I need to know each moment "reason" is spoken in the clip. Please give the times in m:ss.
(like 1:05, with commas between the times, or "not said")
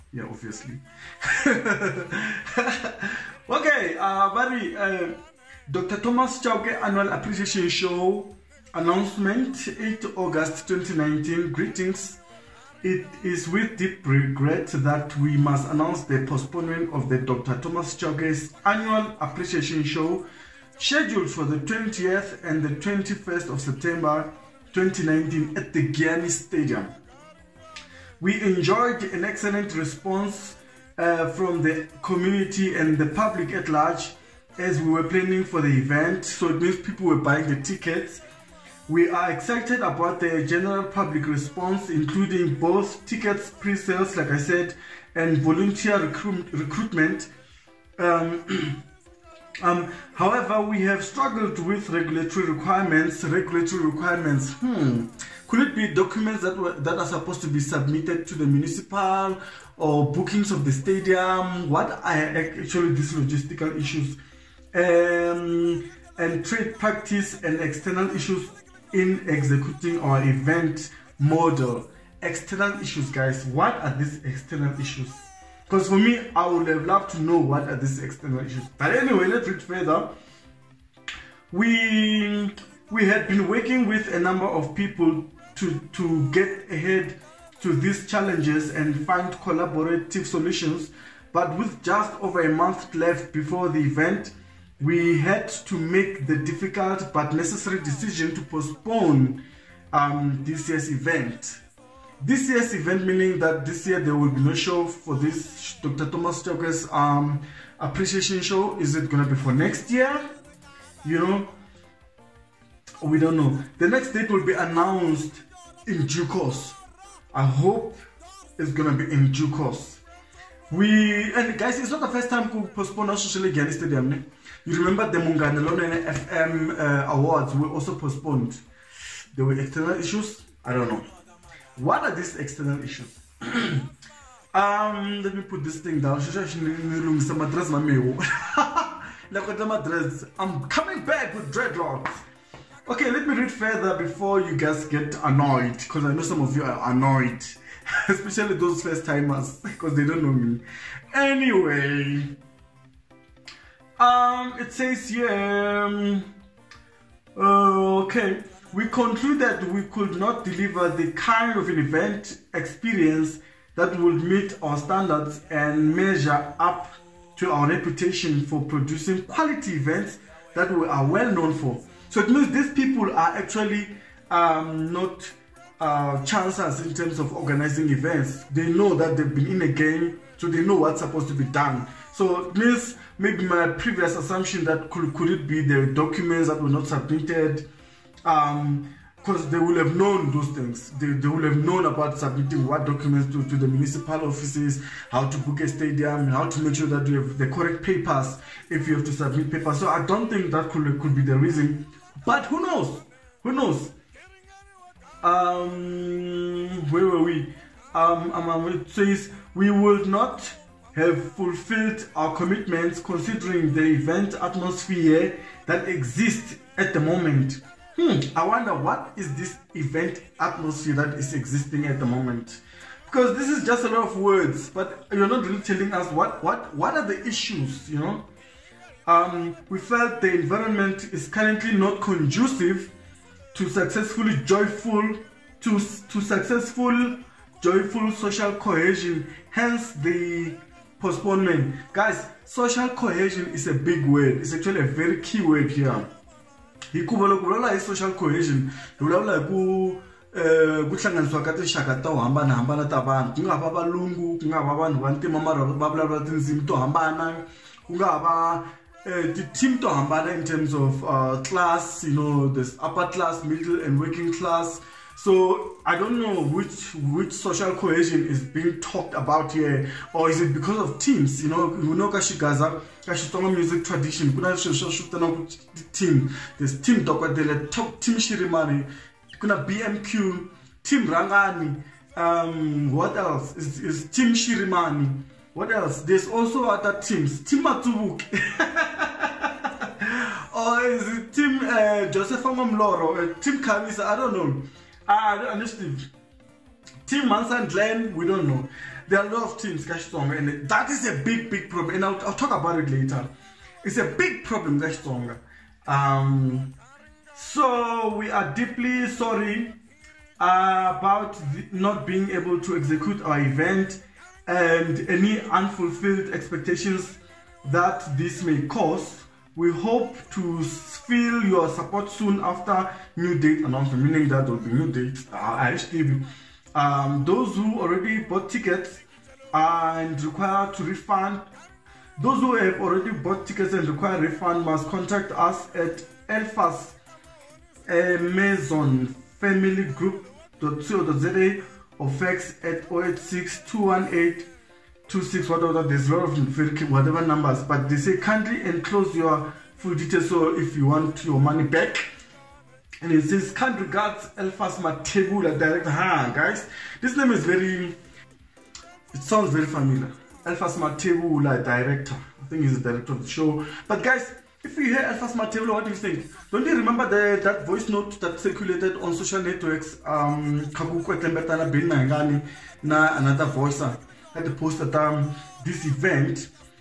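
3:21.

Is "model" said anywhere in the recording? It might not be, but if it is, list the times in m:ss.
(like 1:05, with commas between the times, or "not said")
1:11.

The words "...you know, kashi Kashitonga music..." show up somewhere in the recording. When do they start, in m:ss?
4:31.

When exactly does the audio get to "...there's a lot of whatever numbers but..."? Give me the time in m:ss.
5:45.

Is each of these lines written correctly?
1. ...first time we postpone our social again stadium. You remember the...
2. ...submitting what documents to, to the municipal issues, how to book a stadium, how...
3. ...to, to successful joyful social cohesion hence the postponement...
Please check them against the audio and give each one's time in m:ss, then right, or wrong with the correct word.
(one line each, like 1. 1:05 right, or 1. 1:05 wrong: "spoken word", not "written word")
1. 2:02 right
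2. 3:12 wrong: "offices", not "issues"
3. 3:55 right.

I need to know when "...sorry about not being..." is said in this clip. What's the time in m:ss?
5:09.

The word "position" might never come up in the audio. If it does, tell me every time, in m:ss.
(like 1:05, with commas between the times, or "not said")
not said.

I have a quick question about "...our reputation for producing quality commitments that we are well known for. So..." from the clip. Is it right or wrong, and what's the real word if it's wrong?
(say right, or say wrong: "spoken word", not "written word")
wrong: "events", not "commitments".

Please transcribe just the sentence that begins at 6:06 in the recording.
Don't you remember the, that voice note that circulated on social networks?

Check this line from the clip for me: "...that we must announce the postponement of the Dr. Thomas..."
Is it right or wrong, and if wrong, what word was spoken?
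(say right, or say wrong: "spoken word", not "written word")
right.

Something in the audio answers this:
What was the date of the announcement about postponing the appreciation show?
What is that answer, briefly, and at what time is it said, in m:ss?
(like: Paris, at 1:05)
8 August 2019, at 0:09.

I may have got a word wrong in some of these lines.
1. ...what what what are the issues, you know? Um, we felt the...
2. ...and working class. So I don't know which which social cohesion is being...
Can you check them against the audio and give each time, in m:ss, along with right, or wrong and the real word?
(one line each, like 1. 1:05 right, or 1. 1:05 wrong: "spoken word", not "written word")
1. 3:46 right
2. 4:23 right.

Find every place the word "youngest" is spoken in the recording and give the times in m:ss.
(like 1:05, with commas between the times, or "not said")
not said.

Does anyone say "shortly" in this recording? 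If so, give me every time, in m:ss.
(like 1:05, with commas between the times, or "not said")
not said.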